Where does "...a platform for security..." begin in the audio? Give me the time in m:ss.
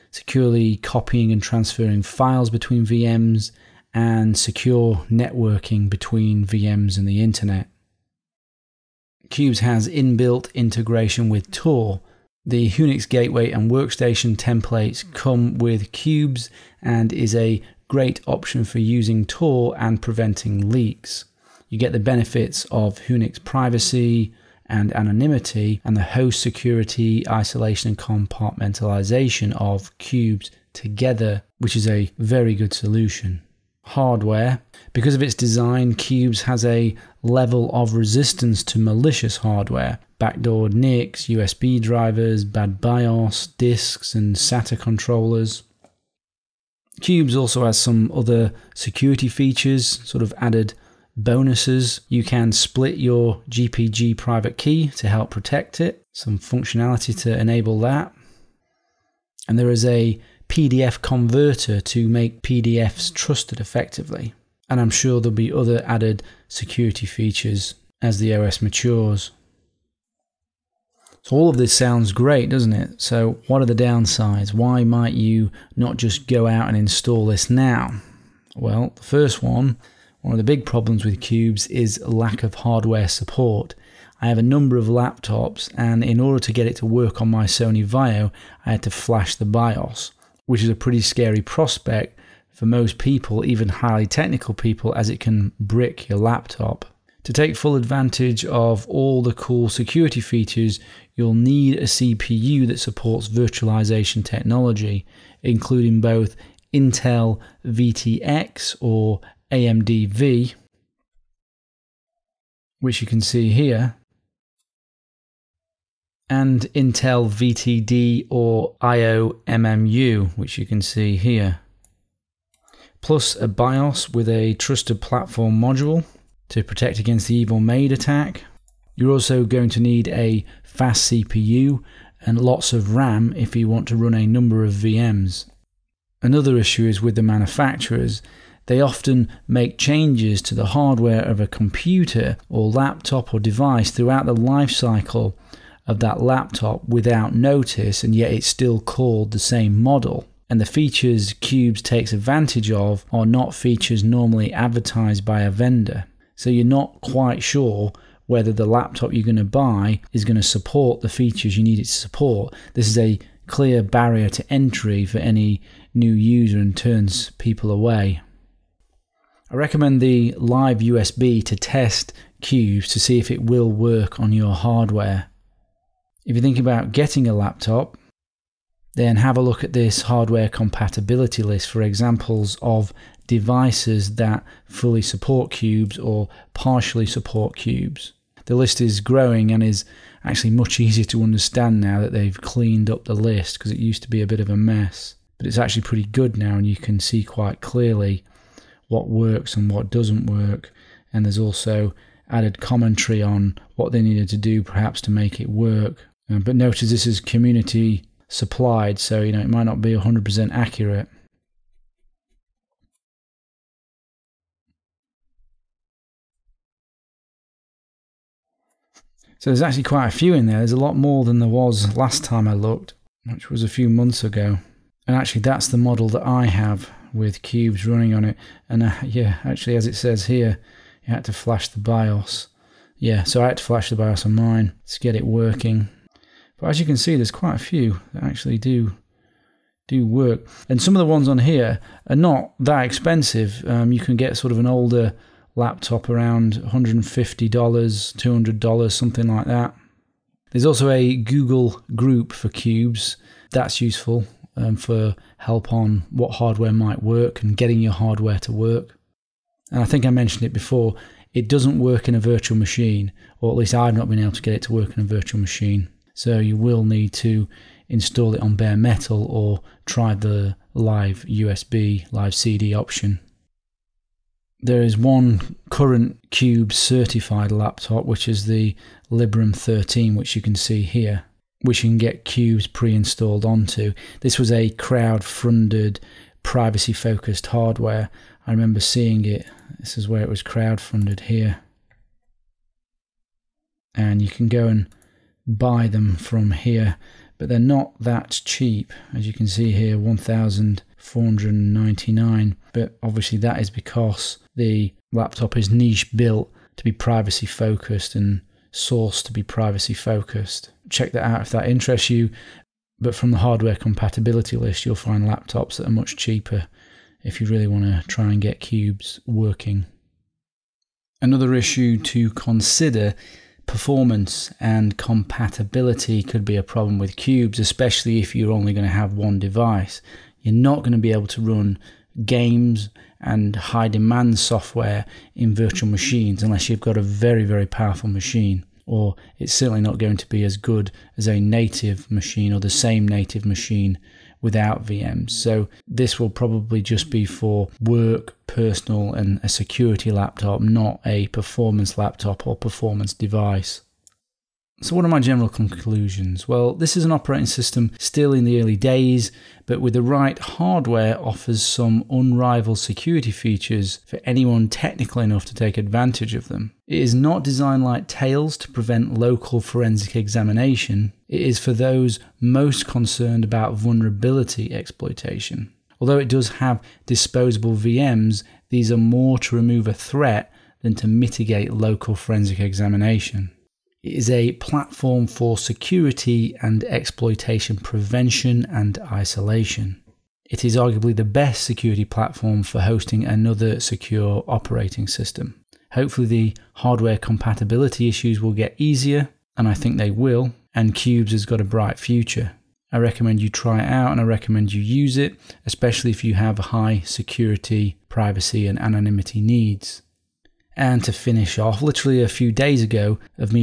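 6:24.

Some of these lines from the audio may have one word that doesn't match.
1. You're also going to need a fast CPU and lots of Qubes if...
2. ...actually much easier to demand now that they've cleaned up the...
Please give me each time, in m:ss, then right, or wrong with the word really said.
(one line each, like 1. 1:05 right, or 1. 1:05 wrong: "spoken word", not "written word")
1. 2:08 wrong: "RAM", not "Qubes"
2. 3:10 wrong: "understand", not "demand".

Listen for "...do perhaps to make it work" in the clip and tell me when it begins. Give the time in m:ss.
3:24.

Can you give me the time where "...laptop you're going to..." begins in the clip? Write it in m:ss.
2:38.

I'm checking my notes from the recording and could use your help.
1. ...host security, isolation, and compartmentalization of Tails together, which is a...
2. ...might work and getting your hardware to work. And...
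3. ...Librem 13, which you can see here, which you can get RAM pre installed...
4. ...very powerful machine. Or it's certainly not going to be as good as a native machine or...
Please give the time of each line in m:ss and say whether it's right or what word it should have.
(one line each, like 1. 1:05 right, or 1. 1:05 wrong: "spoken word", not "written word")
1. 0:26 wrong: "Qubes", not "Tails"
2. 4:16 right
3. 4:39 wrong: "Qubes", not "RAM"
4. 5:37 right.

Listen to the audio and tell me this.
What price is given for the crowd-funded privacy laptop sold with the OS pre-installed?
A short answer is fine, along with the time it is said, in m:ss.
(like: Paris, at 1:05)
1,499, at 4:59.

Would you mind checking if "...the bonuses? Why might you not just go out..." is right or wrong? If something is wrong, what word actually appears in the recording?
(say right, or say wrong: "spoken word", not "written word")
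wrong: "downsides", not "bonuses".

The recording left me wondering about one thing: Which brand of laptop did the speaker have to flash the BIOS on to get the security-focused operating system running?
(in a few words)
Sony Vaio.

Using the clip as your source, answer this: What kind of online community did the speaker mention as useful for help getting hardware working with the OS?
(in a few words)
Google group.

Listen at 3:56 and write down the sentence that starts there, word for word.
But as you can see, there's quite a few that actually do do work.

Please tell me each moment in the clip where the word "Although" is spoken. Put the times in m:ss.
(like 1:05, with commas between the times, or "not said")
6:16.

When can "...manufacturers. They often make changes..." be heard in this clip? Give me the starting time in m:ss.
2:17.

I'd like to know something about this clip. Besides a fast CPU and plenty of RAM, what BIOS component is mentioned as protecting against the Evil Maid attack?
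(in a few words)
trusted platform module.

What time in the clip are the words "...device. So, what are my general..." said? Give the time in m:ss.
5:53.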